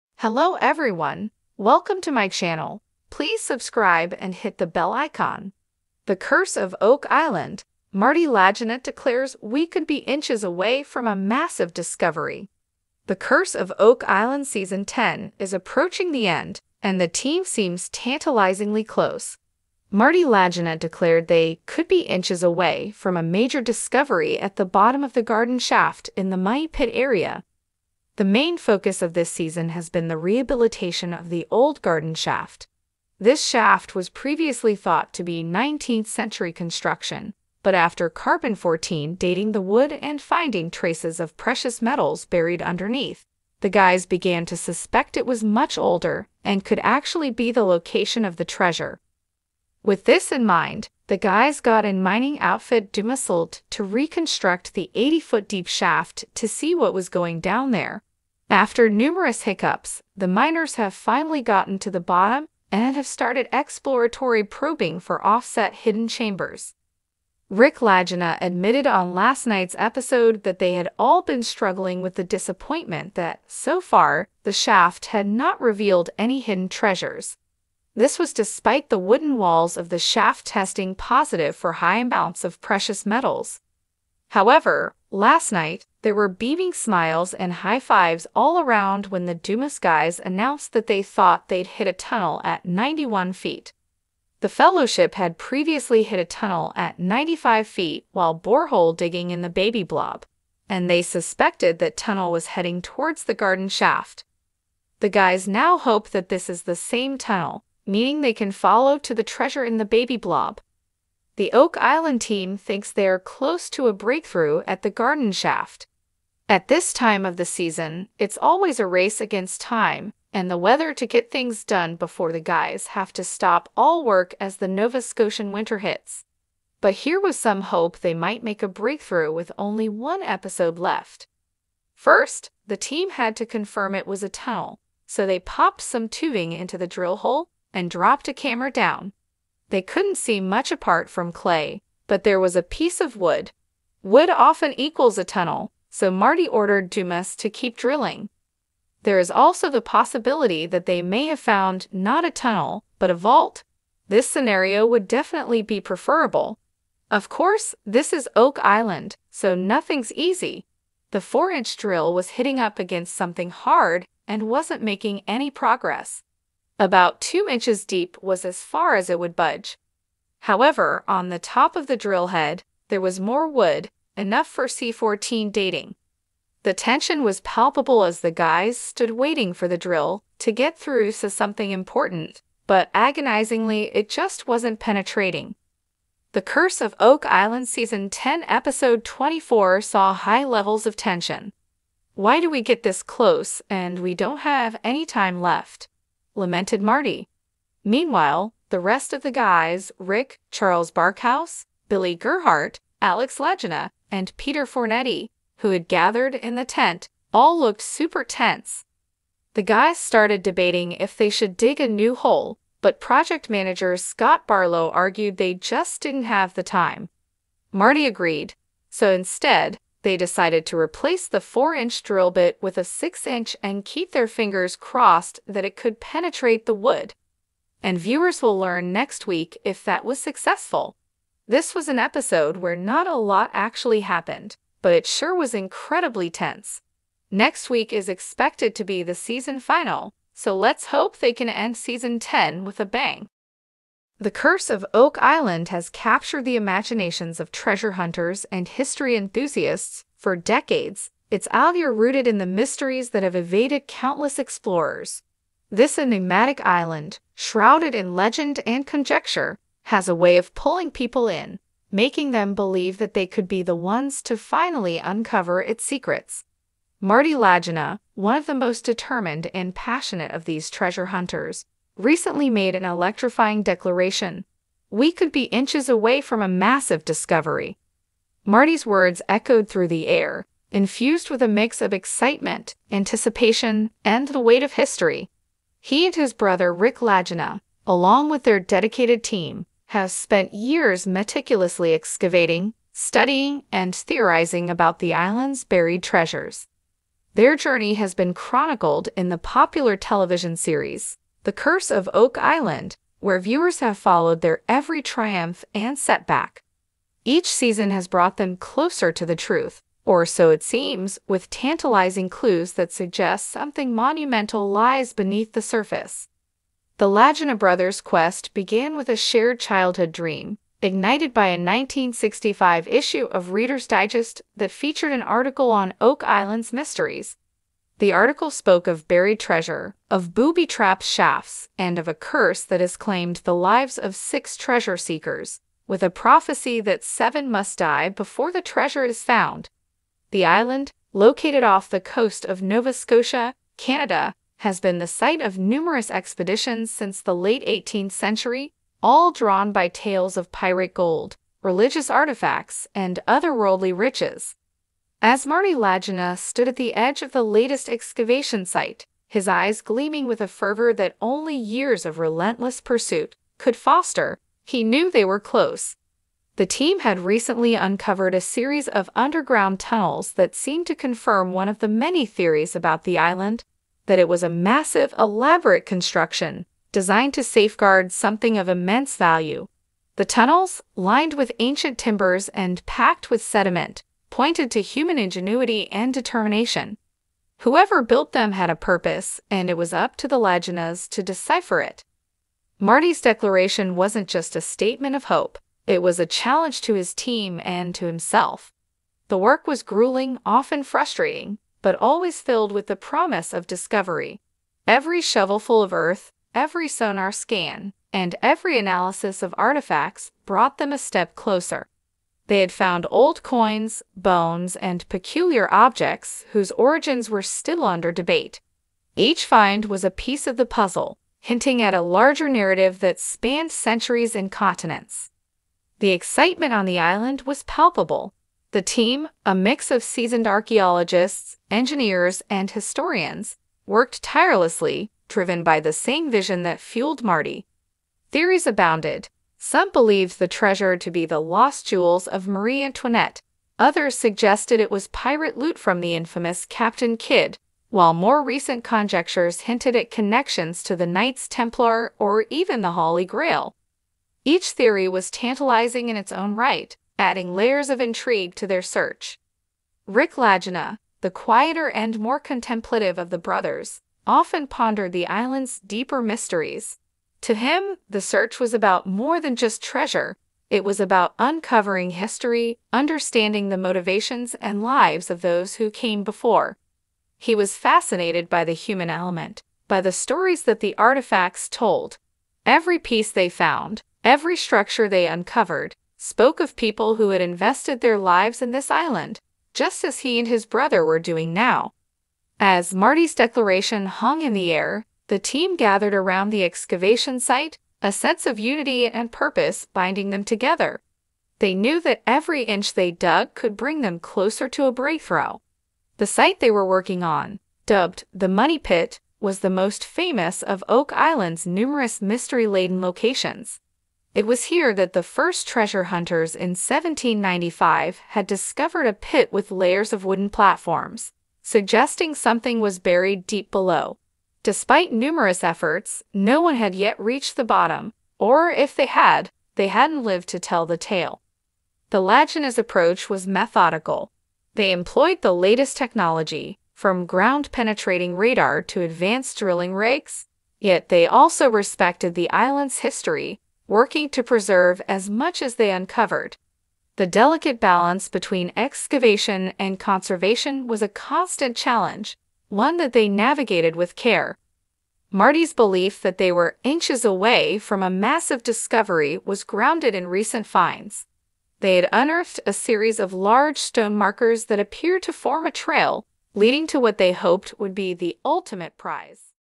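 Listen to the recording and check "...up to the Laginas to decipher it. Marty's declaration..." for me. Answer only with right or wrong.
right.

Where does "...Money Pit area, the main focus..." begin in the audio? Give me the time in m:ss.
0:26.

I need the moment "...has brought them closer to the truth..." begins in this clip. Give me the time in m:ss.
5:07.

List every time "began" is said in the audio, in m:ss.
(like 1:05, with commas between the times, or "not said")
0:44, 5:18.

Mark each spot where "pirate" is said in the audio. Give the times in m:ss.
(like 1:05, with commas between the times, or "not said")
5:50, 7:25.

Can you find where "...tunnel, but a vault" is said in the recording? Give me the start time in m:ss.
2:32.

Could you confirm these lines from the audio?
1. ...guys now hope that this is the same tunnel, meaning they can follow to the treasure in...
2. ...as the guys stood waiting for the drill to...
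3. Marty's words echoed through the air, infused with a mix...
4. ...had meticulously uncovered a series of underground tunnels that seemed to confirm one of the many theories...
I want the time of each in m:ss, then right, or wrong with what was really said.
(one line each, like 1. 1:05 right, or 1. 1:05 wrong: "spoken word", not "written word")
1. 1:45 right
2. 2:58 right
3. 4:38 right
4. 6:06 wrong: "recently", not "meticulously".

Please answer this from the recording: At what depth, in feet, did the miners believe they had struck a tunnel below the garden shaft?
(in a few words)
91.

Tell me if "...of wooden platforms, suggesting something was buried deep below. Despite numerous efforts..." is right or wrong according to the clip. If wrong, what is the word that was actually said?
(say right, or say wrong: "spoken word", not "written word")
right.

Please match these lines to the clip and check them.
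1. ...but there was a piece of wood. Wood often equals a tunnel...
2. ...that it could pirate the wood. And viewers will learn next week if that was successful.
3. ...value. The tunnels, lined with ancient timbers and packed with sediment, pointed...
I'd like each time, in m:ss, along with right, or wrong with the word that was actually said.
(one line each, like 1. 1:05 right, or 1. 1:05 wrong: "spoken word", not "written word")
1. 2:22 right
2. 3:45 wrong: "penetrate", not "pirate"
3. 6:19 right.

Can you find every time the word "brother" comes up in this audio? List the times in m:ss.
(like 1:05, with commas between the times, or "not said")
4:46, 5:17, 7:43, 8:10.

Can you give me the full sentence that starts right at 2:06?
But here was some hope they might make a breakthrough with only one episode left.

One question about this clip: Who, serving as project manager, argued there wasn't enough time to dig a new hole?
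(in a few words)
Scott Barlow.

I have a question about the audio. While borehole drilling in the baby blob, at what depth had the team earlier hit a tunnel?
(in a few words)
95 feet.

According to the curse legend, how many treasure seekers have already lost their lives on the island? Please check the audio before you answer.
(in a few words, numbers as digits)
6.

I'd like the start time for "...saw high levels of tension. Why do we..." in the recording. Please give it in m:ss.
3:09.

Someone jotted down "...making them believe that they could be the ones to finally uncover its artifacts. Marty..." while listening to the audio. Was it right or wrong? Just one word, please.
wrong.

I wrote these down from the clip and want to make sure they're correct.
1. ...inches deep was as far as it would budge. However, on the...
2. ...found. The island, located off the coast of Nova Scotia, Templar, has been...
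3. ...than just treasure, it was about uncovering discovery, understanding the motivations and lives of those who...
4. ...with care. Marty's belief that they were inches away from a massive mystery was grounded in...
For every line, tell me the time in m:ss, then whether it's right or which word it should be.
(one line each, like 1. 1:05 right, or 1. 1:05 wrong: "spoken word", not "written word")
1. 2:47 right
2. 5:39 wrong: "Canada", not "Templar"
3. 7:49 wrong: "history", not "discovery"
4. 9:13 wrong: "discovery", not "mystery".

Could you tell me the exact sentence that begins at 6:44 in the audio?
Every shovelful of earth, every sonar scan, and every analysis of artifacts brought them a step closer.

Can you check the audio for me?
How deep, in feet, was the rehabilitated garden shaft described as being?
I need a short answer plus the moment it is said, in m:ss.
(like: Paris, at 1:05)
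80, at 0:54.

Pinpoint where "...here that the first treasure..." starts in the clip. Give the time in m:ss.
8:34.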